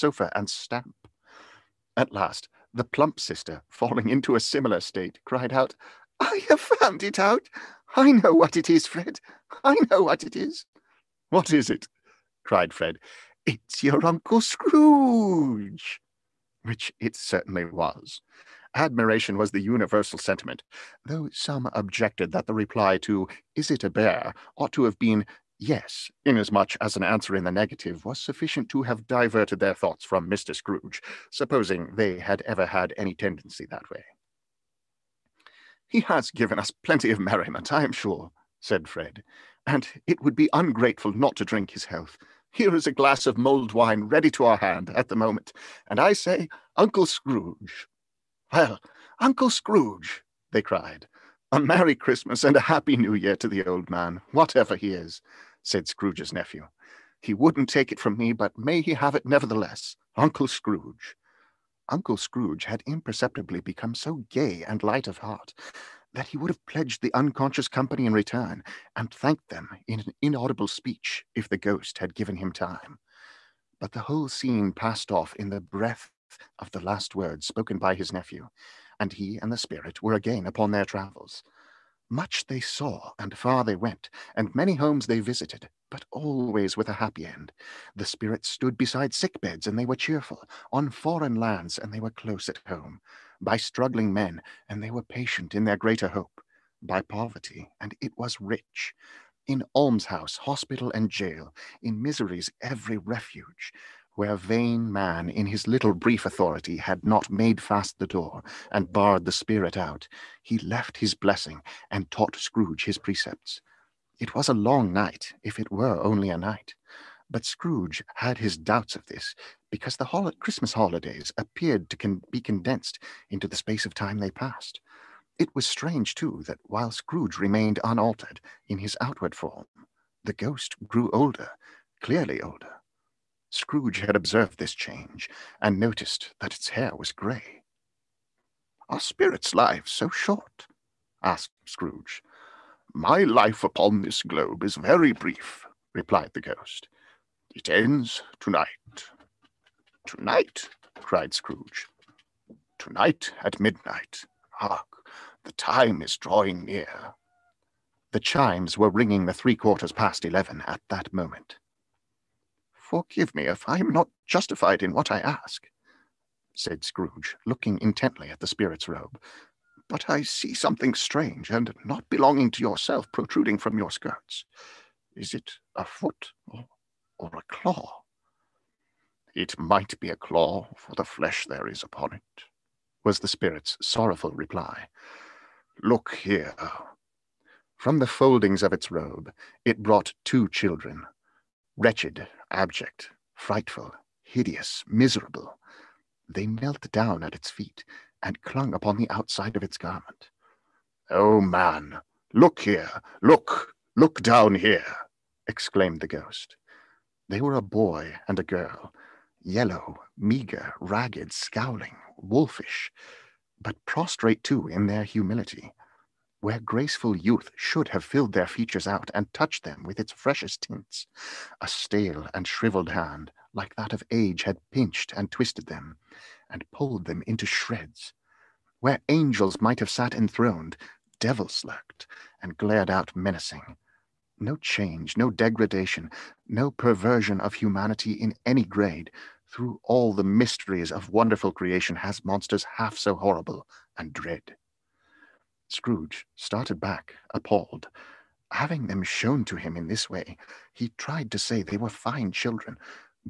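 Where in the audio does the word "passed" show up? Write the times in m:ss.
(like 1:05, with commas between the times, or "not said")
1:14, 2:04.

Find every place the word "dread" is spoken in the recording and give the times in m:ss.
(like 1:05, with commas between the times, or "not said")
4:04.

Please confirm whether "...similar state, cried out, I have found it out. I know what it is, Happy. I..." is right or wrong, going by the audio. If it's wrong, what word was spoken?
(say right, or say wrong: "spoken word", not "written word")
wrong: "Fred", not "Happy".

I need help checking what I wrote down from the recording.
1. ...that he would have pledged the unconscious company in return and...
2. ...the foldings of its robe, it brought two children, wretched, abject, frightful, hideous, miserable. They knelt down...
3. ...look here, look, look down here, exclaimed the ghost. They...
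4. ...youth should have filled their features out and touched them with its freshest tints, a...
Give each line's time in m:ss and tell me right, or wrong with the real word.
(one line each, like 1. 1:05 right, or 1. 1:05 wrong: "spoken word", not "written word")
1. 1:06 right
2. 3:07 right
3. 3:22 right
4. 3:37 right.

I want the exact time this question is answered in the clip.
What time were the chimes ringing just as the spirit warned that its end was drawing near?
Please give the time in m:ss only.
2:39.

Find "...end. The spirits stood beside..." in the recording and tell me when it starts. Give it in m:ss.
1:27.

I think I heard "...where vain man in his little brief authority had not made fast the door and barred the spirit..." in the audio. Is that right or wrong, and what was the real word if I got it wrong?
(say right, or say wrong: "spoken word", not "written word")
right.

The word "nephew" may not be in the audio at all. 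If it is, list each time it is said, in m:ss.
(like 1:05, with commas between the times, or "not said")
0:56, 1:18.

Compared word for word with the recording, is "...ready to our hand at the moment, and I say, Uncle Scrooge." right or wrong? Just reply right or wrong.
right.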